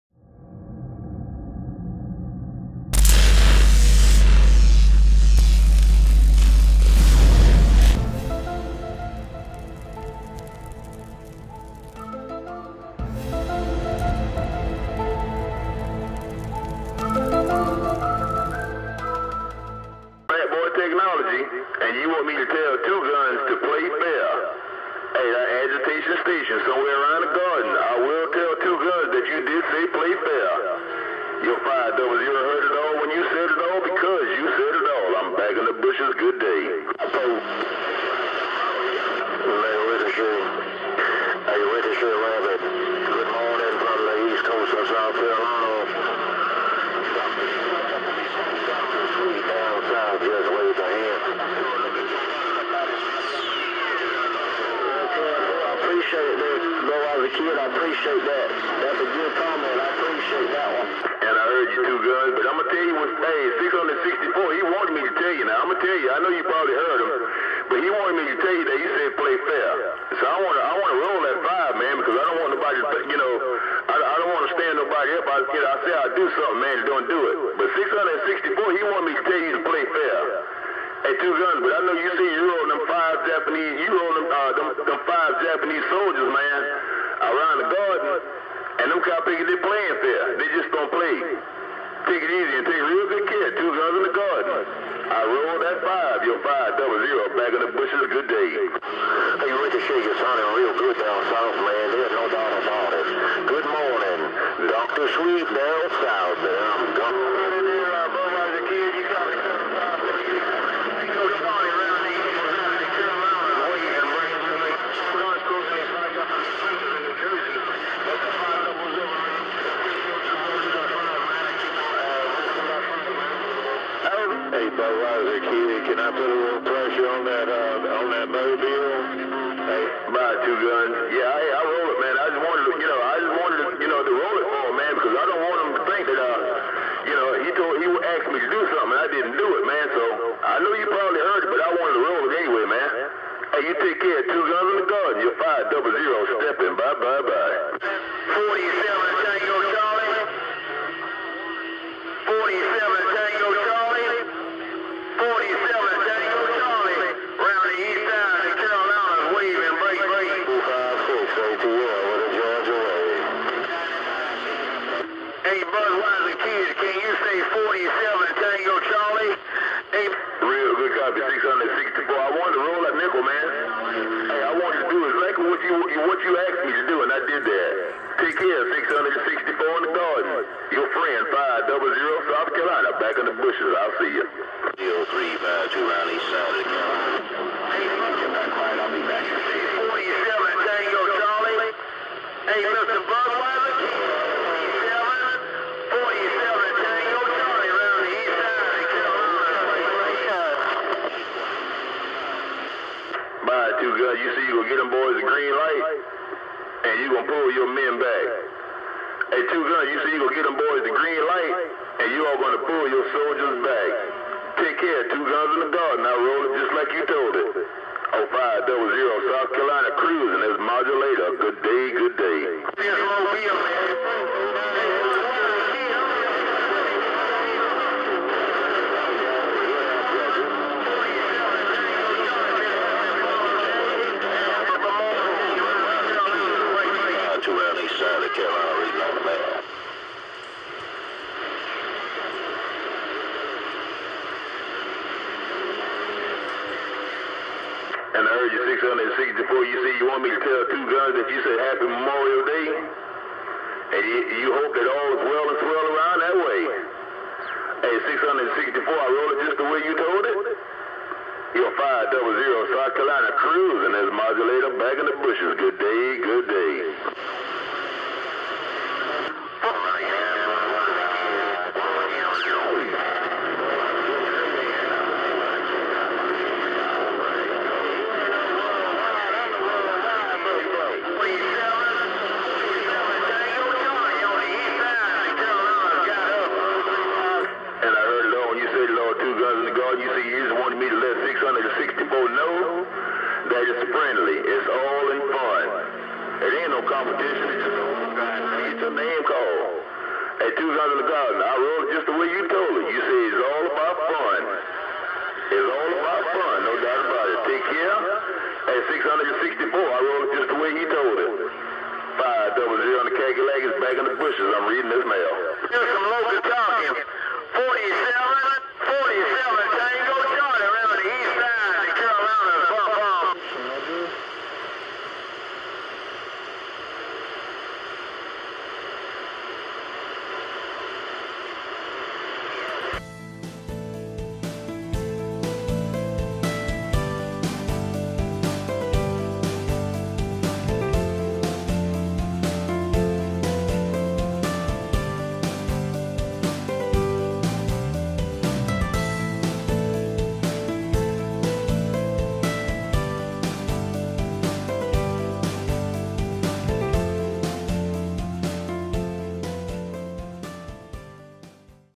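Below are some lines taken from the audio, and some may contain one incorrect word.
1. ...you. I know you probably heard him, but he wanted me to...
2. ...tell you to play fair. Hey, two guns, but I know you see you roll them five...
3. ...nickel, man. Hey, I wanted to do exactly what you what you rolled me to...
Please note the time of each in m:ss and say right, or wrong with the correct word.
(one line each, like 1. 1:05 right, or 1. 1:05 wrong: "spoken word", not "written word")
1. 1:06 right
2. 1:19 right
3. 2:52 wrong: "asked", not "rolled".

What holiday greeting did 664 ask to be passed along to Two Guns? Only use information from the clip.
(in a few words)
Happy Memorial Day.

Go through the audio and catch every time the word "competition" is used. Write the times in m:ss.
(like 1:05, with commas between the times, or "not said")
4:56.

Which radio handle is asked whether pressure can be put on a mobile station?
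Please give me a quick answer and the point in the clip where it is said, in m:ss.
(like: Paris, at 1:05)
Budweiser, at 2:04.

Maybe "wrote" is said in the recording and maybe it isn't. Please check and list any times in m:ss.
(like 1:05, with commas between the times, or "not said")
5:01, 5:09.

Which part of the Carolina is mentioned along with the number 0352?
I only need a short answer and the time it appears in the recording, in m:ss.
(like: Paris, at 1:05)
east side, at 3:06.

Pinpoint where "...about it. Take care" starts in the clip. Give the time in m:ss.
5:07.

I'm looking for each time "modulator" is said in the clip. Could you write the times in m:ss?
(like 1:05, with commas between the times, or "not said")
3:40, 4:24.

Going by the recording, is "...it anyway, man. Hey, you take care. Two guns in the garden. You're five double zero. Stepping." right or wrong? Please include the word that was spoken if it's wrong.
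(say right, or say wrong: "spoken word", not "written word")
right.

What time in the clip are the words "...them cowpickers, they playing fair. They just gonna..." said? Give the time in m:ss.
1:28.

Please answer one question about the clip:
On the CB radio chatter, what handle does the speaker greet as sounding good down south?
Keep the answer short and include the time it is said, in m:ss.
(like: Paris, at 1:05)
Ricochet, at 1:39.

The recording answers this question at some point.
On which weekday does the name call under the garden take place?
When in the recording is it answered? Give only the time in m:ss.
5:00.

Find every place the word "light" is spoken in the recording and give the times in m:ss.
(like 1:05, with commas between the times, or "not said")
3:25, 3:31.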